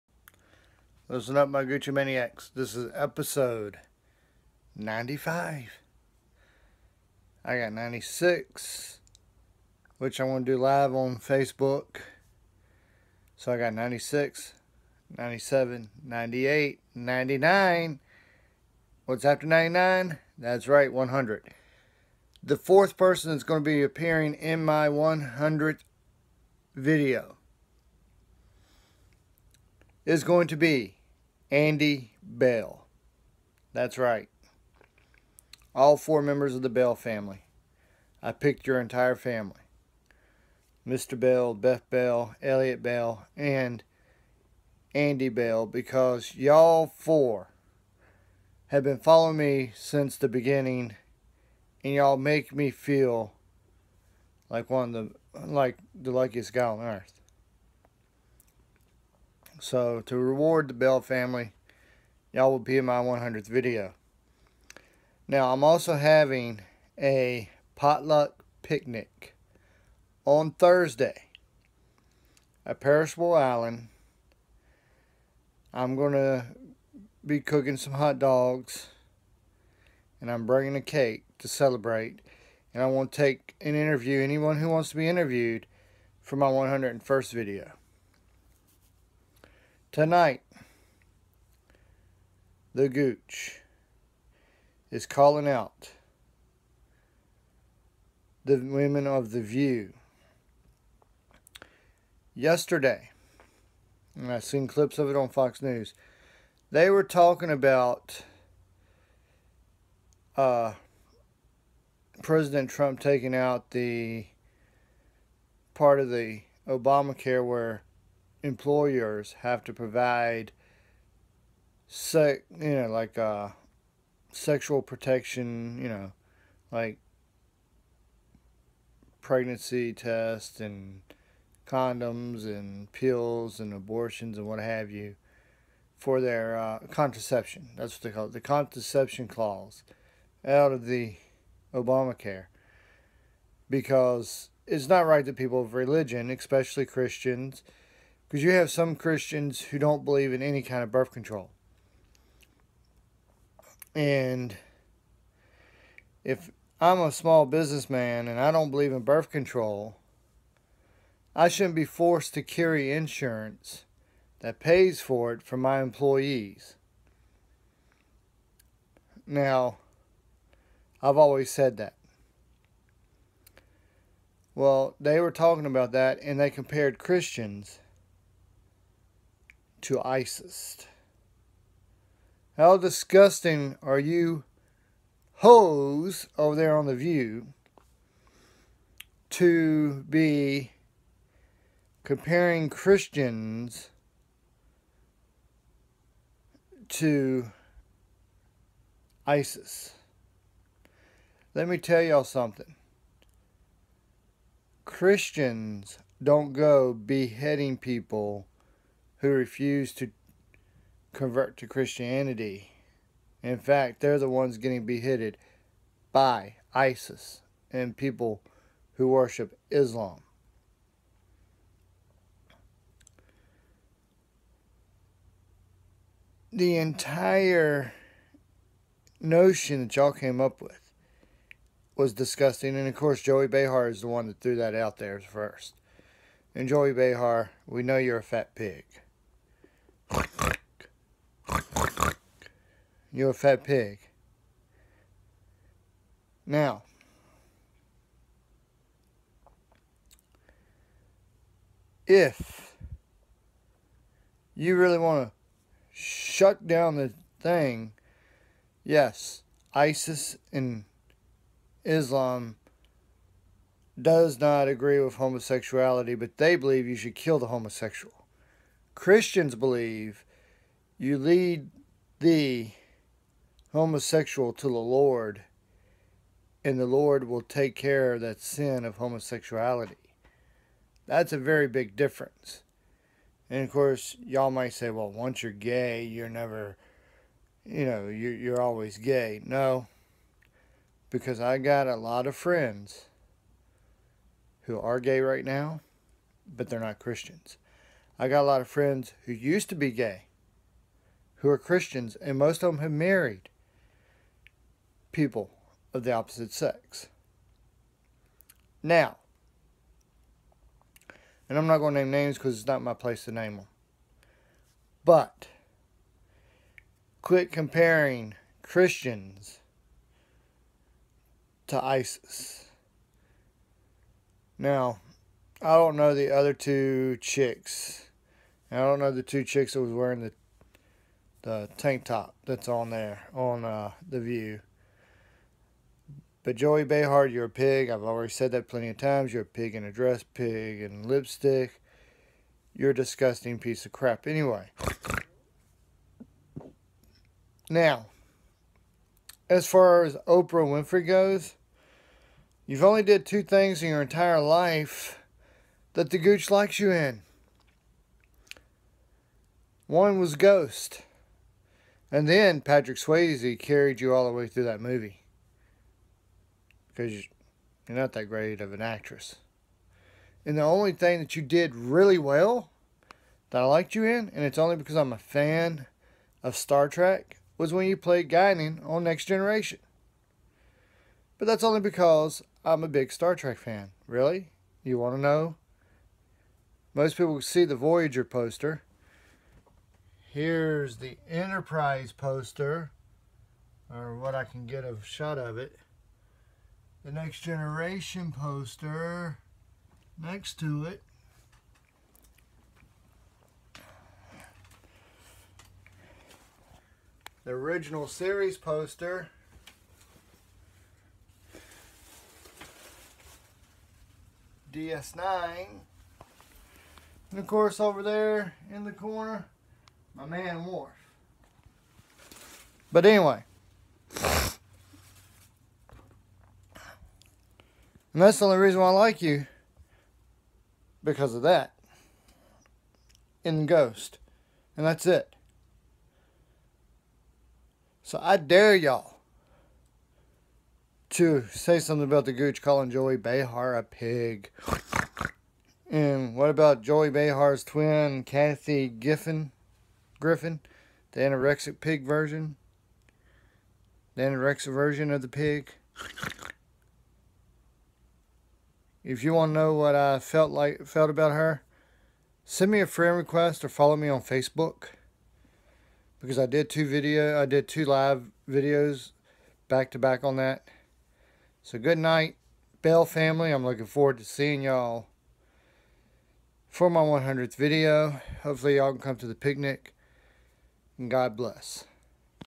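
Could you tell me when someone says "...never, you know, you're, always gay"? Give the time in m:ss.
4:46.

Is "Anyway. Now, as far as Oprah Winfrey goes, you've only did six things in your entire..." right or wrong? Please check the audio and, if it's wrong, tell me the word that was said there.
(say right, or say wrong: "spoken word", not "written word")
wrong: "two", not "six".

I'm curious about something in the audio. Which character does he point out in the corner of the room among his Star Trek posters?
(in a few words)
Worf.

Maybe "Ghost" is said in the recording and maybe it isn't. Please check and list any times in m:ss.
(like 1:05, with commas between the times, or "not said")
6:00, 7:13.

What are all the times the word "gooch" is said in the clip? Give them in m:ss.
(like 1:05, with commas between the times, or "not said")
1:32, 5:56, 7:22.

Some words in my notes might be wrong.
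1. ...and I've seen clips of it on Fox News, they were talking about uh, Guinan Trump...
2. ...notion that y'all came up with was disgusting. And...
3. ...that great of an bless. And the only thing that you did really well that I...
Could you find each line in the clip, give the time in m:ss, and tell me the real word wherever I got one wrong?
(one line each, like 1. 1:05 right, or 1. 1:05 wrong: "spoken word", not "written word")
1. 1:44 wrong: "President", not "Guinan"
2. 3:49 right
3. 6:08 wrong: "actress", not "bless".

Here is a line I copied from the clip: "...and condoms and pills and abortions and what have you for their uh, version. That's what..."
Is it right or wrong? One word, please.
wrong.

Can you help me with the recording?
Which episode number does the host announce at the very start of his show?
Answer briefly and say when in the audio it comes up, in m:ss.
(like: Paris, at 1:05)
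95, at 0:04.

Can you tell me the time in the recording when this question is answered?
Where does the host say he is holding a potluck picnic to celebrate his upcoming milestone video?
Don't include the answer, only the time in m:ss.
1:12.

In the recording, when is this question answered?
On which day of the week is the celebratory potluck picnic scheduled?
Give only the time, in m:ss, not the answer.
1:10.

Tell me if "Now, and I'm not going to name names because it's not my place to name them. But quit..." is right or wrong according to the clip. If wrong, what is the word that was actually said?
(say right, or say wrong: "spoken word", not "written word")
right.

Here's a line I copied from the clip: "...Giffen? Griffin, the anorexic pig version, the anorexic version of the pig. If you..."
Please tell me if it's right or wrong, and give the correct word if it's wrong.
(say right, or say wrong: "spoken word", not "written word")
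right.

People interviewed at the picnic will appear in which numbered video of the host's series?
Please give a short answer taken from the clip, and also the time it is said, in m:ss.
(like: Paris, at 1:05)
101st, at 1:26.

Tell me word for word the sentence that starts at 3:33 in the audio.
In fact, they're the ones getting beheaded by ISIS and people who worship Islam.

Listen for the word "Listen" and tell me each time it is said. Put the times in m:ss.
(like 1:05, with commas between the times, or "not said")
0:01.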